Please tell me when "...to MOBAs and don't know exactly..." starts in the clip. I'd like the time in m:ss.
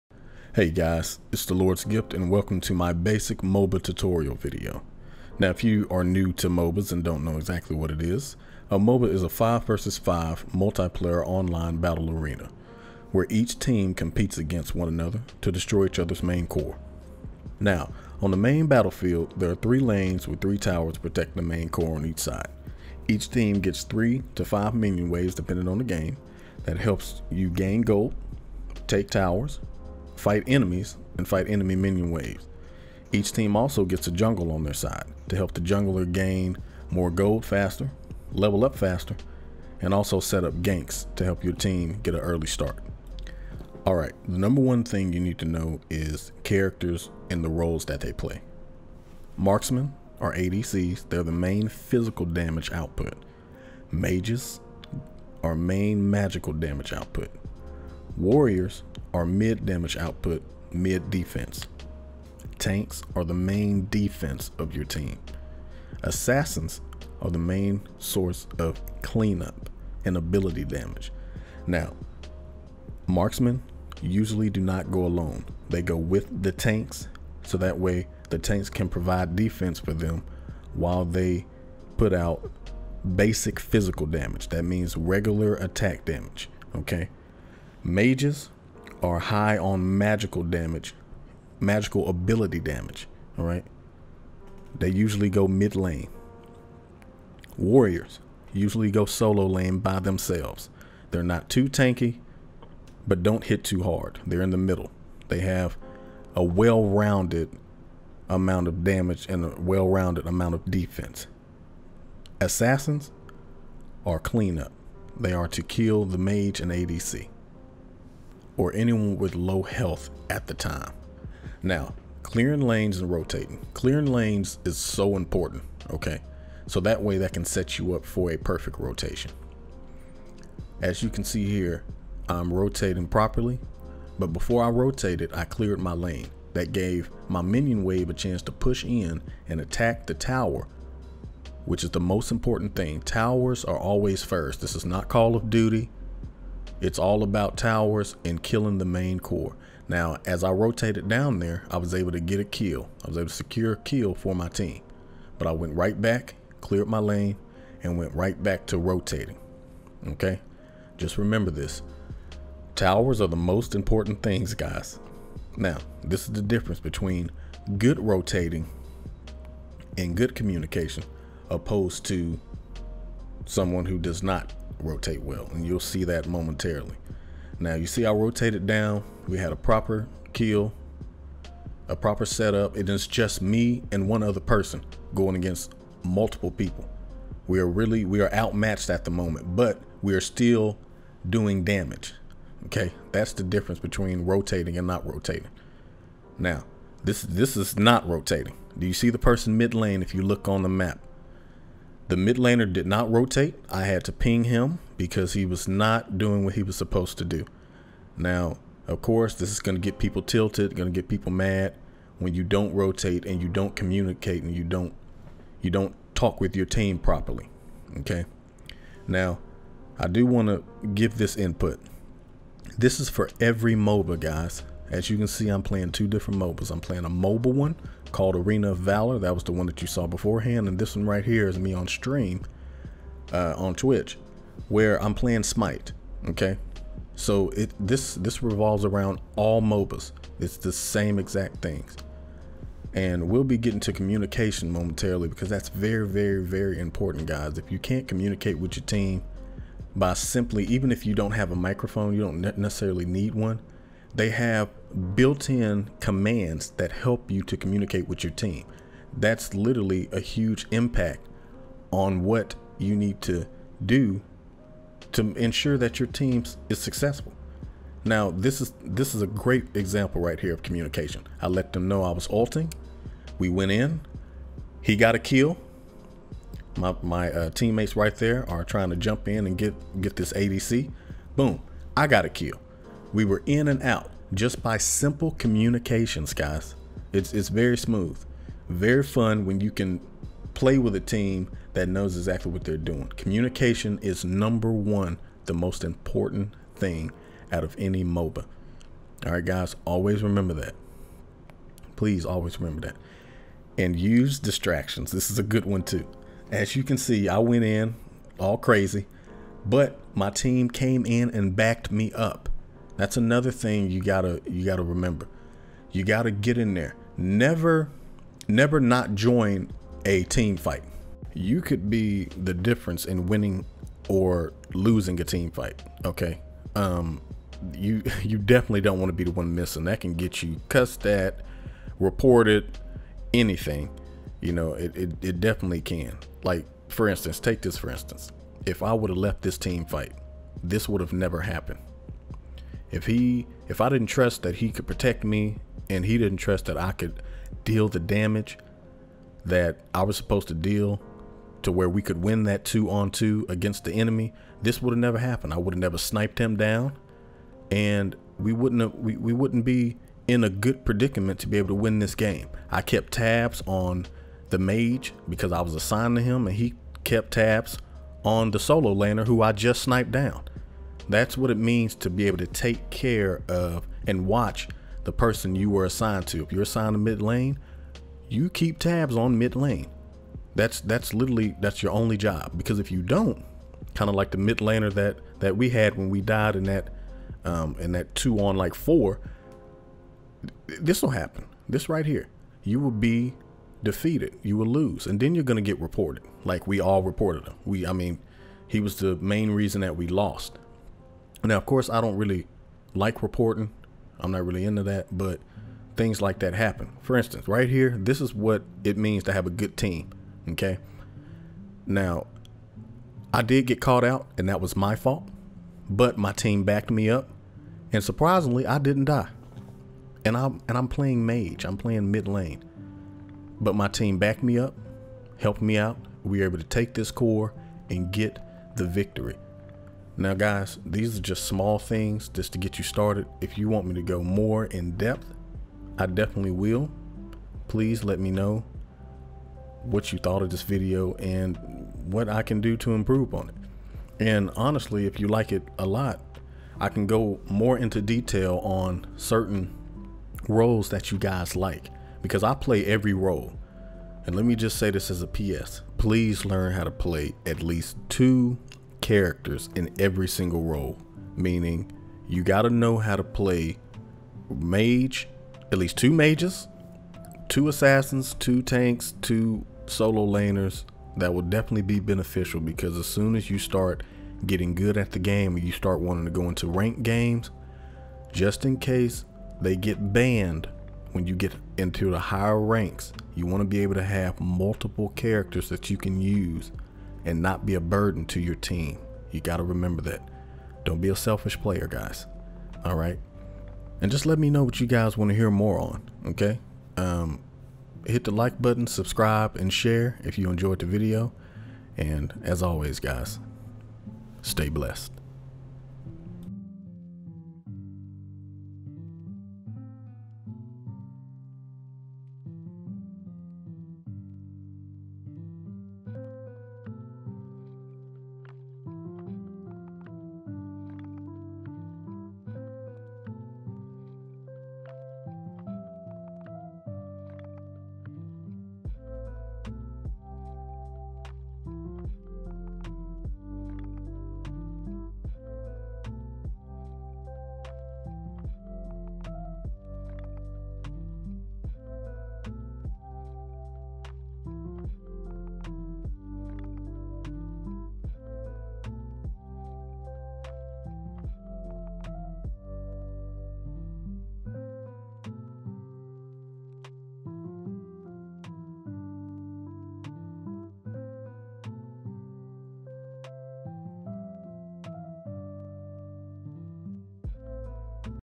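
0:06.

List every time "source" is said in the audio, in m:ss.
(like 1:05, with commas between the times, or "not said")
1:07.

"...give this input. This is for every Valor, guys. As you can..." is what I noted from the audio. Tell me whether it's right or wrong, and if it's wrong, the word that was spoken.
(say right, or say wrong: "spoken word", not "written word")
wrong: "MOBA", not "Valor".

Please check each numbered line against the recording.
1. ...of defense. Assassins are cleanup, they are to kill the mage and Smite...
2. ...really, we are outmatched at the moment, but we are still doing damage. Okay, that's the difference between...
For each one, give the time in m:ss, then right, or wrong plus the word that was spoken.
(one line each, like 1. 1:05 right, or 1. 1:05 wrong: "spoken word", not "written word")
1. 1:50 wrong: "ADC", not "Smite"
2. 3:07 right.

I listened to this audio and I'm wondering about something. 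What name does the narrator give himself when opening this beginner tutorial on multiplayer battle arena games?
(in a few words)
The Lord's Gift.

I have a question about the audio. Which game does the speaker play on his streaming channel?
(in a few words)
Smite.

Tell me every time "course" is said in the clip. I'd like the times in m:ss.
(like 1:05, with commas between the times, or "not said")
3:29, 6:41.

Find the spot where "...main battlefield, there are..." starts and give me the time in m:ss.
0:18.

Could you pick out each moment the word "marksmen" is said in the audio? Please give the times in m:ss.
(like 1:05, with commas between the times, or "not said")
0:49, 1:13.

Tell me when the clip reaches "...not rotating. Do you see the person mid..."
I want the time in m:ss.
3:17.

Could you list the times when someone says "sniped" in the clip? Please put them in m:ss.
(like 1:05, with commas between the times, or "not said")
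5:55, 6:09.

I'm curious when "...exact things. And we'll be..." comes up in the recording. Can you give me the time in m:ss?
4:01.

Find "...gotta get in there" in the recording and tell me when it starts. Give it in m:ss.
5:16.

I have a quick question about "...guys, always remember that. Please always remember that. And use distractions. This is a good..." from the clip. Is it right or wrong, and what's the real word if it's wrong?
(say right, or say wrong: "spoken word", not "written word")
right.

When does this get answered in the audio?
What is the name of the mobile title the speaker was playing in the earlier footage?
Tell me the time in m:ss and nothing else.
3:48.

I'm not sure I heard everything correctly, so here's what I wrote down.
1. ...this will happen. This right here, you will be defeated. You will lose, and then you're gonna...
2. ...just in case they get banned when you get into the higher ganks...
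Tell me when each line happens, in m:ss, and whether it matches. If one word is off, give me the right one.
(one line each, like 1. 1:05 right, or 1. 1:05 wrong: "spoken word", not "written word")
1. 6:30 right
2. 7:58 wrong: "ranks", not "ganks".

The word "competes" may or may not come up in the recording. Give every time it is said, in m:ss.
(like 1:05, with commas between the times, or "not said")
0:13.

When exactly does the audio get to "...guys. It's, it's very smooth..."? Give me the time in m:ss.
4:46.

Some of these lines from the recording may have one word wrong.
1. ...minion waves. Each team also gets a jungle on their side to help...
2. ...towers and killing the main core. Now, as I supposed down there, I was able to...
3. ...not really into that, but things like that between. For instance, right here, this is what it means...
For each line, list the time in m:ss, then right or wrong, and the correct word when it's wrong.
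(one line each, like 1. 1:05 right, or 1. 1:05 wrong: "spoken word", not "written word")
1. 0:31 right
2. 2:27 wrong: "rotated", not "supposed"
3. 6:44 wrong: "happen", not "between".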